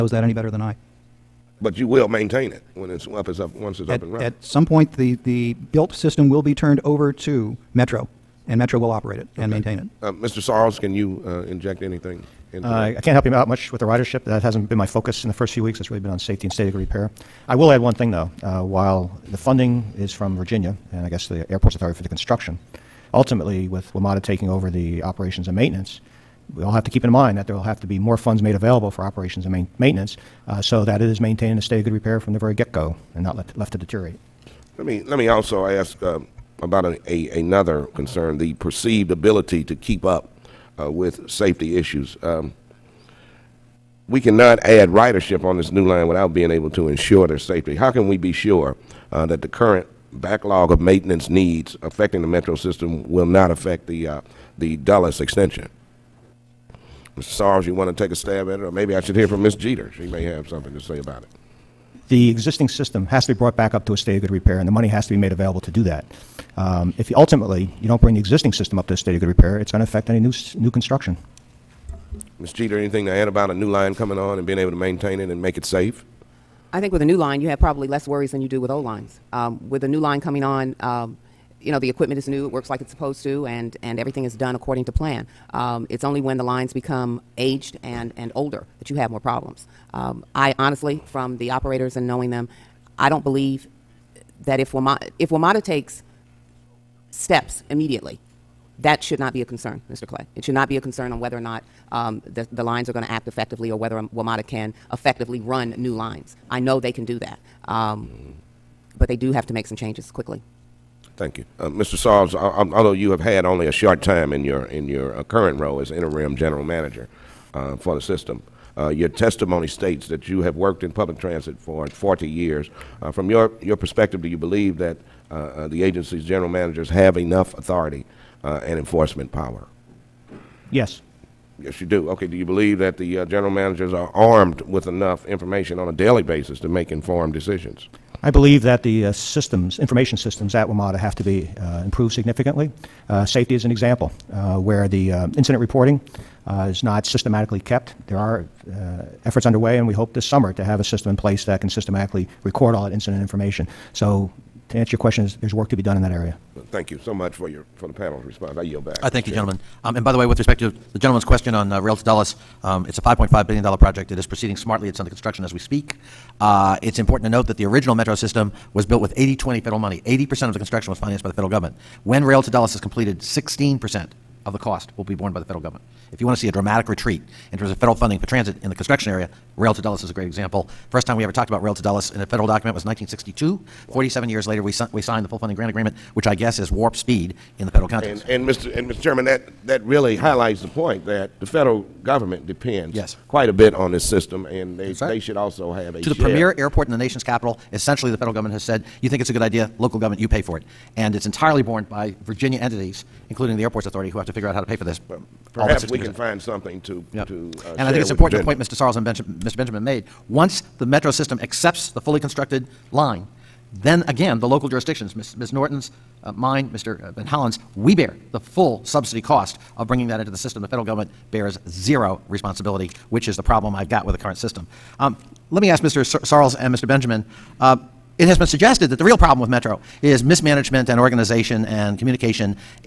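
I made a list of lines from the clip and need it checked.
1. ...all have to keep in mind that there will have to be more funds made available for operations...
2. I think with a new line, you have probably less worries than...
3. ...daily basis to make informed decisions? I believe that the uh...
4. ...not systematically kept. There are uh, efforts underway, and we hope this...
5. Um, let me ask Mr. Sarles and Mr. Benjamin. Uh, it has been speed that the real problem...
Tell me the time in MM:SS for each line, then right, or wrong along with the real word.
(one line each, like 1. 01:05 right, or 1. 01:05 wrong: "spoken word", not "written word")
1. 00:26 right
2. 01:16 right
3. 02:15 right
4. 02:26 right
5. 03:44 wrong: "suggested", not "speed".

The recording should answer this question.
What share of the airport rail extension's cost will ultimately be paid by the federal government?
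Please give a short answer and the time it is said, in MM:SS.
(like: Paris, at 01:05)
16%, at 02:53.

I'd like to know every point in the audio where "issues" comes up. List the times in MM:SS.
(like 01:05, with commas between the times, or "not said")
00:41.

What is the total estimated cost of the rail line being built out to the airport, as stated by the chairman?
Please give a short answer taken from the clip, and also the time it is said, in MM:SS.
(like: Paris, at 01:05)
$5.5 billion, at 02:43.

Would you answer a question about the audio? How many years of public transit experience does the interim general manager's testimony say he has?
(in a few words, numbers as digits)
40 years.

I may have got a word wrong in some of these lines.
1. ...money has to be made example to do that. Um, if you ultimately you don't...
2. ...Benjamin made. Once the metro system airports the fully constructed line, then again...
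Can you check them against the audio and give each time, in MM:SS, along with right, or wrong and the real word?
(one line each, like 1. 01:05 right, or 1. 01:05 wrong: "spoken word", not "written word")
1. 01:04 wrong: "available", not "example"
2. 03:29 wrong: "accepts", not "airports".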